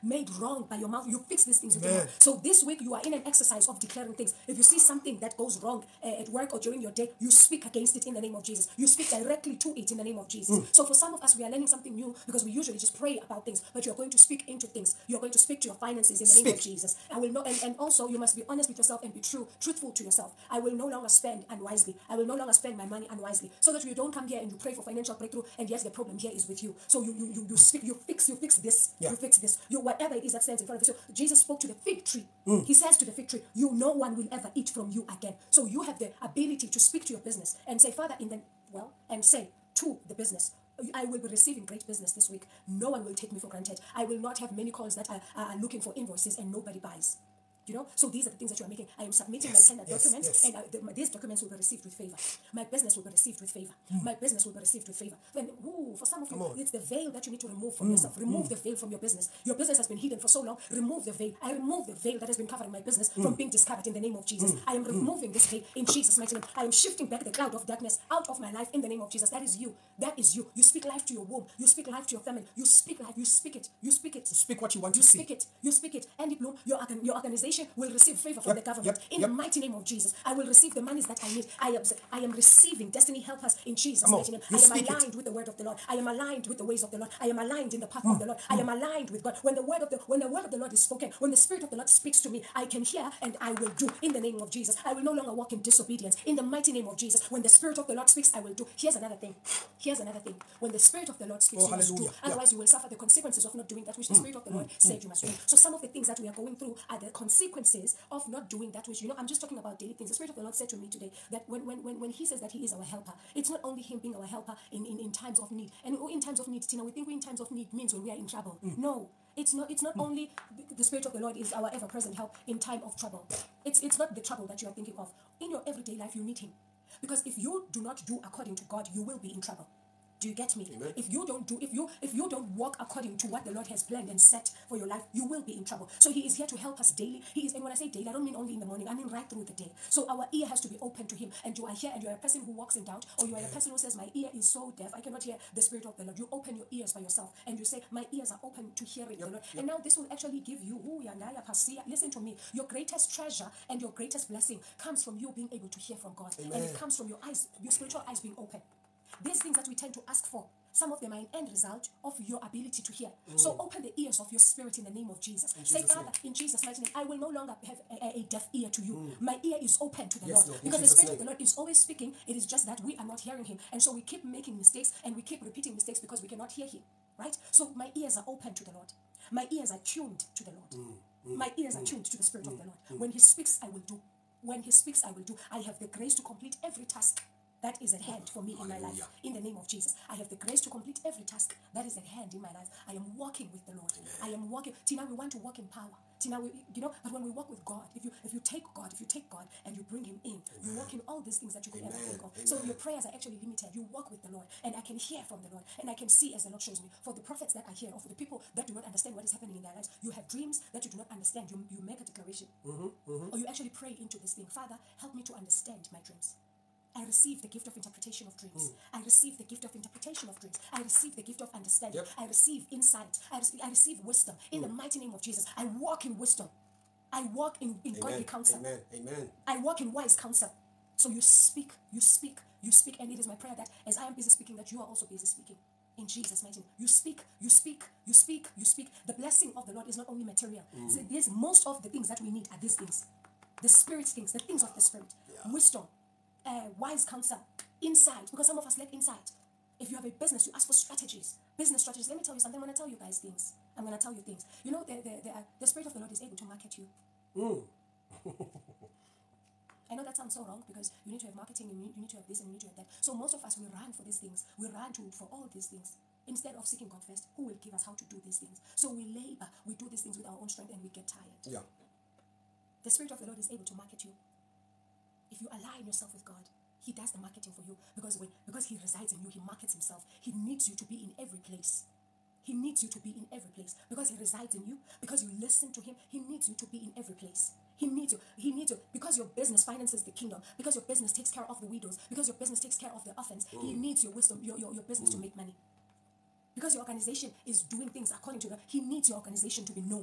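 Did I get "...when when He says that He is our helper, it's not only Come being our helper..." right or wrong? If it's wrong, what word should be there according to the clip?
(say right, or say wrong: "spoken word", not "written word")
wrong: "Him", not "Come".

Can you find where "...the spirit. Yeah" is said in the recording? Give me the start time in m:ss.
4:04.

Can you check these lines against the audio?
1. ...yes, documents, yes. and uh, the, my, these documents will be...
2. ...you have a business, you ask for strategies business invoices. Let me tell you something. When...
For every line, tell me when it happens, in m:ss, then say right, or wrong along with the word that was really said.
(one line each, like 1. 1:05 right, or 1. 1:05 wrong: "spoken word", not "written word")
1. 0:49 right
2. 4:09 wrong: "strategies", not "invoices".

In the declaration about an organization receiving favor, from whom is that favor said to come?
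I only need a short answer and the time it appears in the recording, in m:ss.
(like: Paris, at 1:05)
The government, at 1:18.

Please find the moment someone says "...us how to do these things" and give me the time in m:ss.
4:27.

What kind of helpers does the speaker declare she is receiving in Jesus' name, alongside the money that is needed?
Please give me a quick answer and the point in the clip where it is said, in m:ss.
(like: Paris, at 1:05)
Destiny helpers, at 1:22.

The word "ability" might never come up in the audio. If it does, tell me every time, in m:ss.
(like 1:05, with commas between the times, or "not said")
0:36, 2:42.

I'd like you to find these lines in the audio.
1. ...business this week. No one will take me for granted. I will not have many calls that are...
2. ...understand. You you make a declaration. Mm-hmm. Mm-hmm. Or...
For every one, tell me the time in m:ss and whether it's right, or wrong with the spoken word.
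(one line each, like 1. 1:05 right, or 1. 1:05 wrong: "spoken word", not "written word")
1. 0:41 right
2. 3:31 right.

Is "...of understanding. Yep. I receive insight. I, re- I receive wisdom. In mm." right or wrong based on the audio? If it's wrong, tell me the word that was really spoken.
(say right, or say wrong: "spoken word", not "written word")
right.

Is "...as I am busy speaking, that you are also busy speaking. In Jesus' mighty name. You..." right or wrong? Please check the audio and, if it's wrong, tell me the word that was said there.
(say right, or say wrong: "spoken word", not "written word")
right.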